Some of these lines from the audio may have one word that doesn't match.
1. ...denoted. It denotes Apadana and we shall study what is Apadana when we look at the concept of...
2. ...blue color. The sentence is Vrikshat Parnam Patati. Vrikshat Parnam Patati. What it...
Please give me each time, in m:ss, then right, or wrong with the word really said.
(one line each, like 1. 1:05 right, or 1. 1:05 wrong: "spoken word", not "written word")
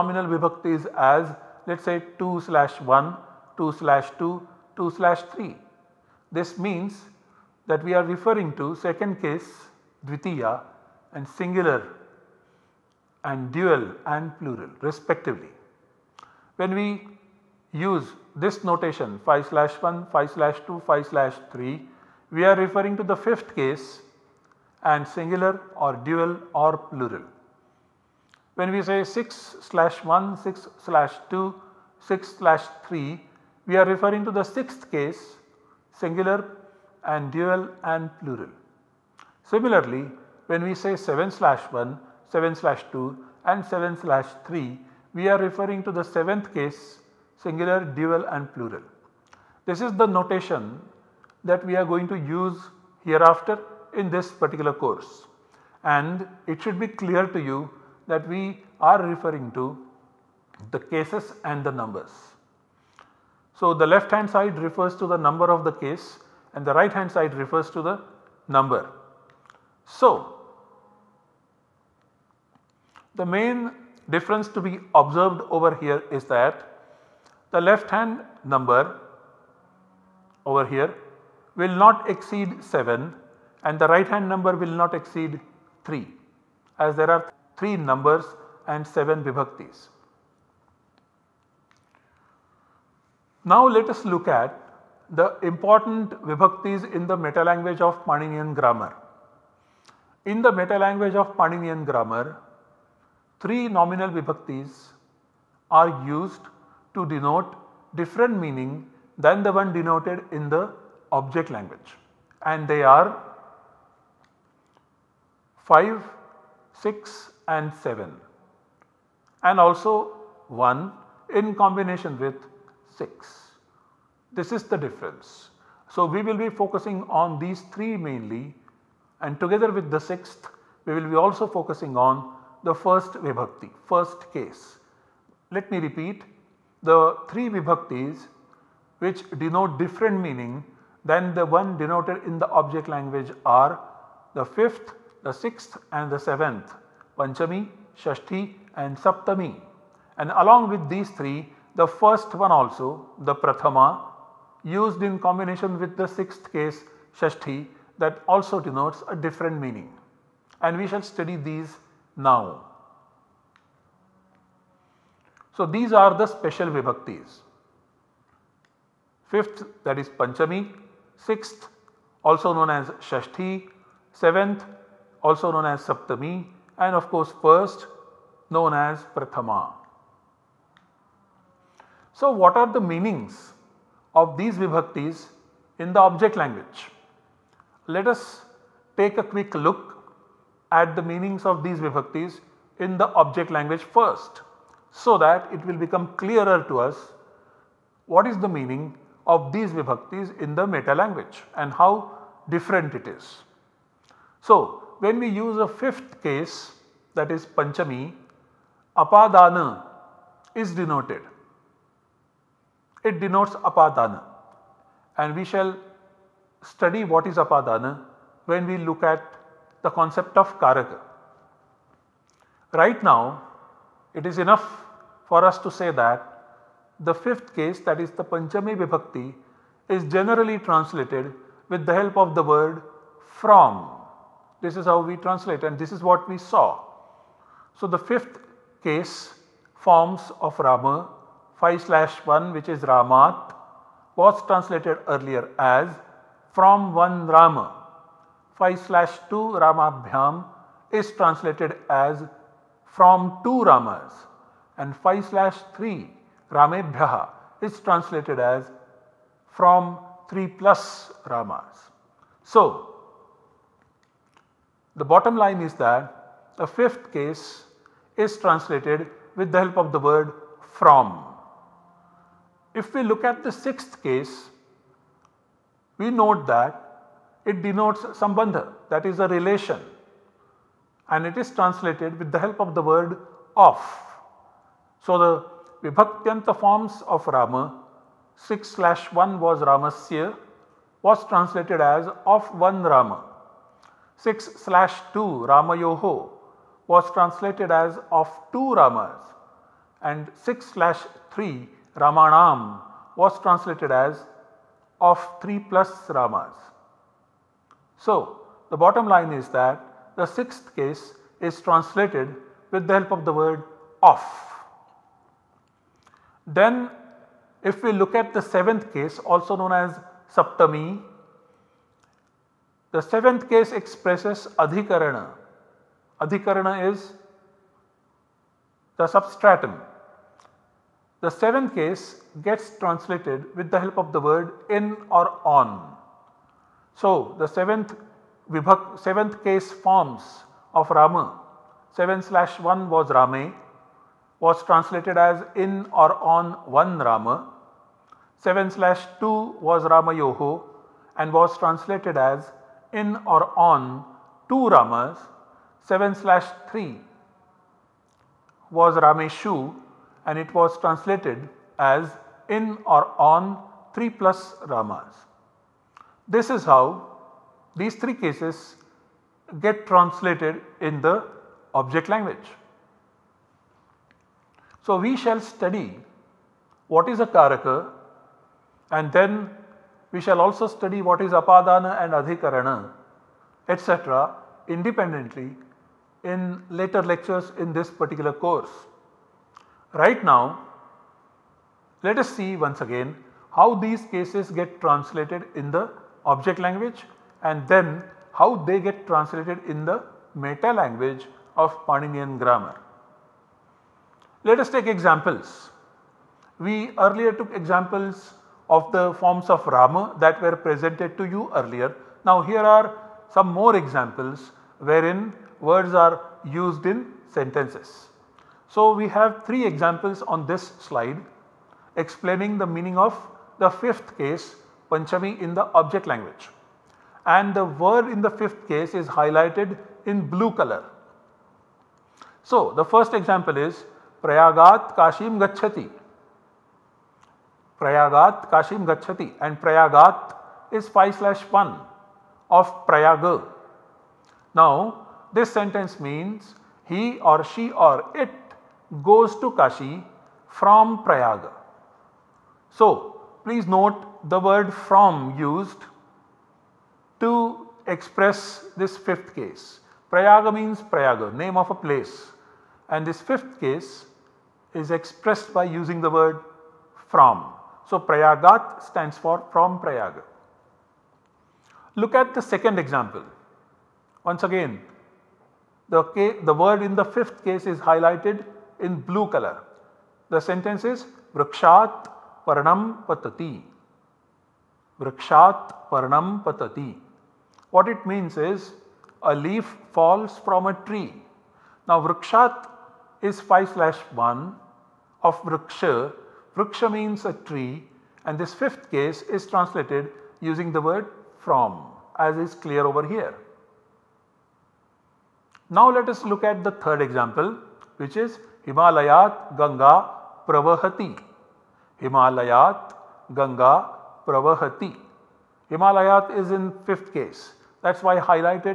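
1. 3:30 right
2. 7:59 right.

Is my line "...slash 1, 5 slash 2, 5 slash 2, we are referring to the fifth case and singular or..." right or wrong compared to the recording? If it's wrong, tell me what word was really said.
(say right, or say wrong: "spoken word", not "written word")
wrong: "3", not "2".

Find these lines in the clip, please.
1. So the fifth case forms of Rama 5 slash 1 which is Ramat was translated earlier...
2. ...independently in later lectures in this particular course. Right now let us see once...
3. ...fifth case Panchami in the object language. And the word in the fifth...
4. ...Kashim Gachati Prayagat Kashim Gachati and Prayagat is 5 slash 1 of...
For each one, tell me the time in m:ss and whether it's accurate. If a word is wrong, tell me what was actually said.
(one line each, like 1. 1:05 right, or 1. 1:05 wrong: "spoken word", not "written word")
1. 3:57 right
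2. 6:24 right
3. 7:03 right
4. 7:14 right.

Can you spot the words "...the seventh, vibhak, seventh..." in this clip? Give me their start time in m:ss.
5:37.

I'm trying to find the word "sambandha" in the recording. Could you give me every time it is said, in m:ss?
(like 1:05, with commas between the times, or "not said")
4:38.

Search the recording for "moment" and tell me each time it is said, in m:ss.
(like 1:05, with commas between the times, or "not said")
not said.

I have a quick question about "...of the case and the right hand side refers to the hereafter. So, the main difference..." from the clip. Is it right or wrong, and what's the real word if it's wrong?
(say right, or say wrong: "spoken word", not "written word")
wrong: "number", not "hereafter".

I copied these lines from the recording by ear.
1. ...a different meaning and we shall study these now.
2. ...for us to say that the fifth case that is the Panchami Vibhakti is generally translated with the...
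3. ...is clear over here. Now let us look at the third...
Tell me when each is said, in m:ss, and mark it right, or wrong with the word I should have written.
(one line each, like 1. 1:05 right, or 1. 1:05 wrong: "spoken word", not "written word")
1. 2:39 right
2. 3:45 right
3. 8:22 right.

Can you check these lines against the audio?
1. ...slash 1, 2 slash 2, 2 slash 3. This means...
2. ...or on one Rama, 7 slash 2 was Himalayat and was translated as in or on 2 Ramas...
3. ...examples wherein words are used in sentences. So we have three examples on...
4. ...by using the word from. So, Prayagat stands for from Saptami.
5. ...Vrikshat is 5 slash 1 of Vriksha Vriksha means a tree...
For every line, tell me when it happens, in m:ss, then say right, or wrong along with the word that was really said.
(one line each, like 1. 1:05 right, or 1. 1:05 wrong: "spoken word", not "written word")
1. 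0:02 right
2. 5:45 wrong: "Ramayoho", not "Himalayat"
3. 6:53 right
4. 7:45 wrong: "Prayag", not "Saptami"
5. 8:12 right.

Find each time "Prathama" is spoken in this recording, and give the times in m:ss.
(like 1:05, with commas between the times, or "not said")
2:33, 2:59.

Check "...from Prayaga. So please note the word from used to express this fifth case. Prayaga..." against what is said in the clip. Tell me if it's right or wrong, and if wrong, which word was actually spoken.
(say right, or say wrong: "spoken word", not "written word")
right.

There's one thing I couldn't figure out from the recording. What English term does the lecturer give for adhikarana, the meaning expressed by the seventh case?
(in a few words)
substratum.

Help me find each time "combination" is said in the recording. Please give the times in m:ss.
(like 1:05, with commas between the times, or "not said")
2:01, 2:35.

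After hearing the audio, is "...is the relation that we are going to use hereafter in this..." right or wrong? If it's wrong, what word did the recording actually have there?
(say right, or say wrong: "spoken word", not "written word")
wrong: "notation", not "relation".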